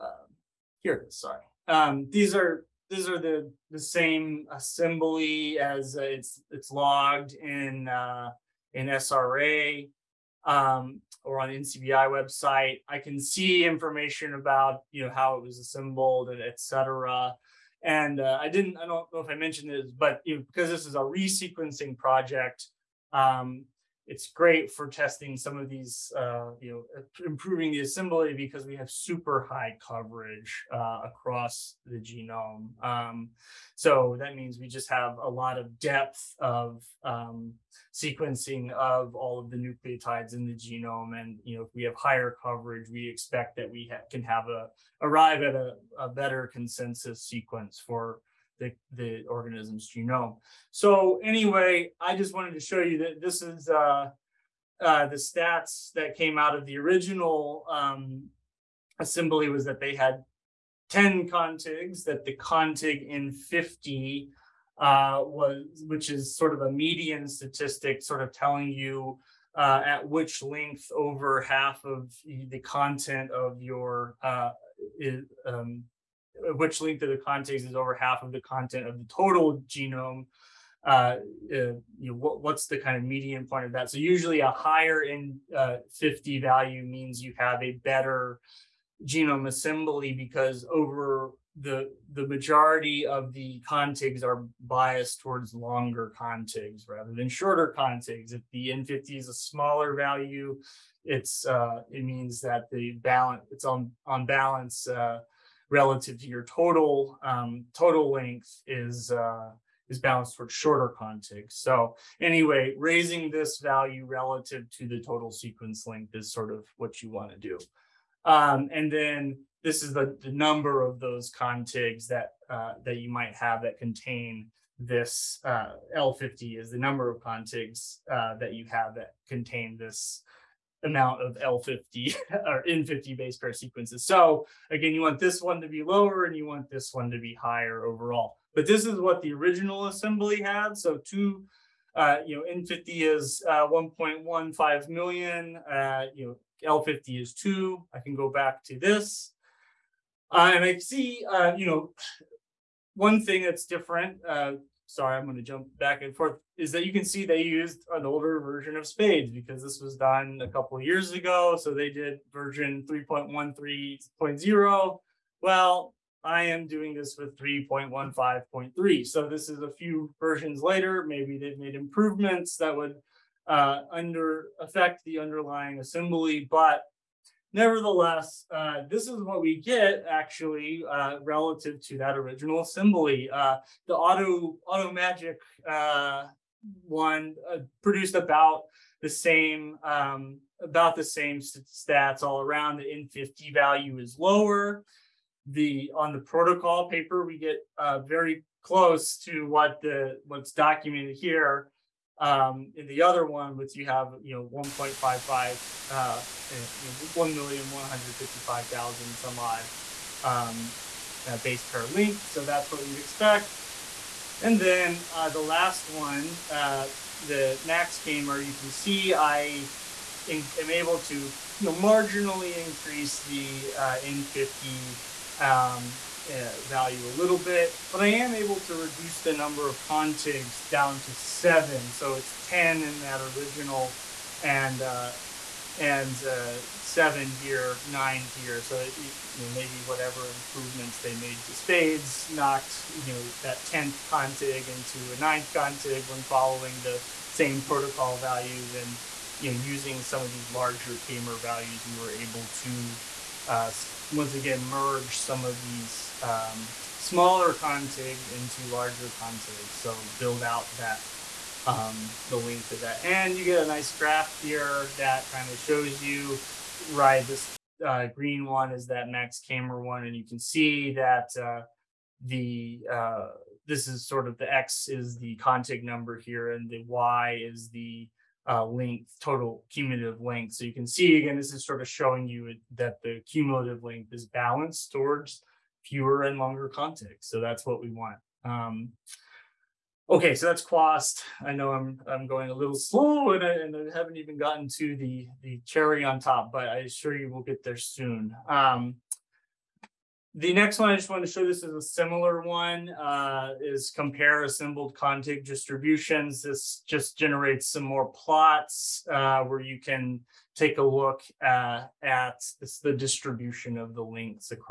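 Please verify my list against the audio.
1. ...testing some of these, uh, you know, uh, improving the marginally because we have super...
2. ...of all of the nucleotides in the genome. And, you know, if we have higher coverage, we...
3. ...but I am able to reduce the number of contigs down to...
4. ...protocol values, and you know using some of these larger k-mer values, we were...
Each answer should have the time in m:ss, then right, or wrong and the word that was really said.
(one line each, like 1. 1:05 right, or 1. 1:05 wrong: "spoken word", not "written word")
1. 0:24 wrong: "assembly", not "marginally"
2. 0:38 right
3. 3:47 right
4. 4:07 right.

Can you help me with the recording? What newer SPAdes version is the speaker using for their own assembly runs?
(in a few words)
3.15.3.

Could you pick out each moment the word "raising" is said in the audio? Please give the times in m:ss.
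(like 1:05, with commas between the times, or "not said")
1:52.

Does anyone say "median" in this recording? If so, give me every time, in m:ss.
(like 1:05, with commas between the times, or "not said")
1:06, 1:23.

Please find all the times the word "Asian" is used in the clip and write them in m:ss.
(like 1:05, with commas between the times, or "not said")
not said.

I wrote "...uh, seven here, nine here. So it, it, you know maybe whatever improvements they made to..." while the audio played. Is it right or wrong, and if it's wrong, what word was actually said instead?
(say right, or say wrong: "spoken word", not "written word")
right.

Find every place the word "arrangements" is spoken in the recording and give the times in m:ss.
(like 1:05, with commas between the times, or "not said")
not said.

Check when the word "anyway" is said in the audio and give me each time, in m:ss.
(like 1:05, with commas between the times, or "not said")
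0:51, 1:52.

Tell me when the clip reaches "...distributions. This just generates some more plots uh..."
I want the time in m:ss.
5:05.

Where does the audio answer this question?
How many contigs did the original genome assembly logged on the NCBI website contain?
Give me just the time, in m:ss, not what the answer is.
1:00.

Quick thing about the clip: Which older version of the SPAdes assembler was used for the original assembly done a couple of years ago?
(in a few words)
3.13.0.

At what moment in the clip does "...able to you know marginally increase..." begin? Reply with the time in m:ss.
3:40.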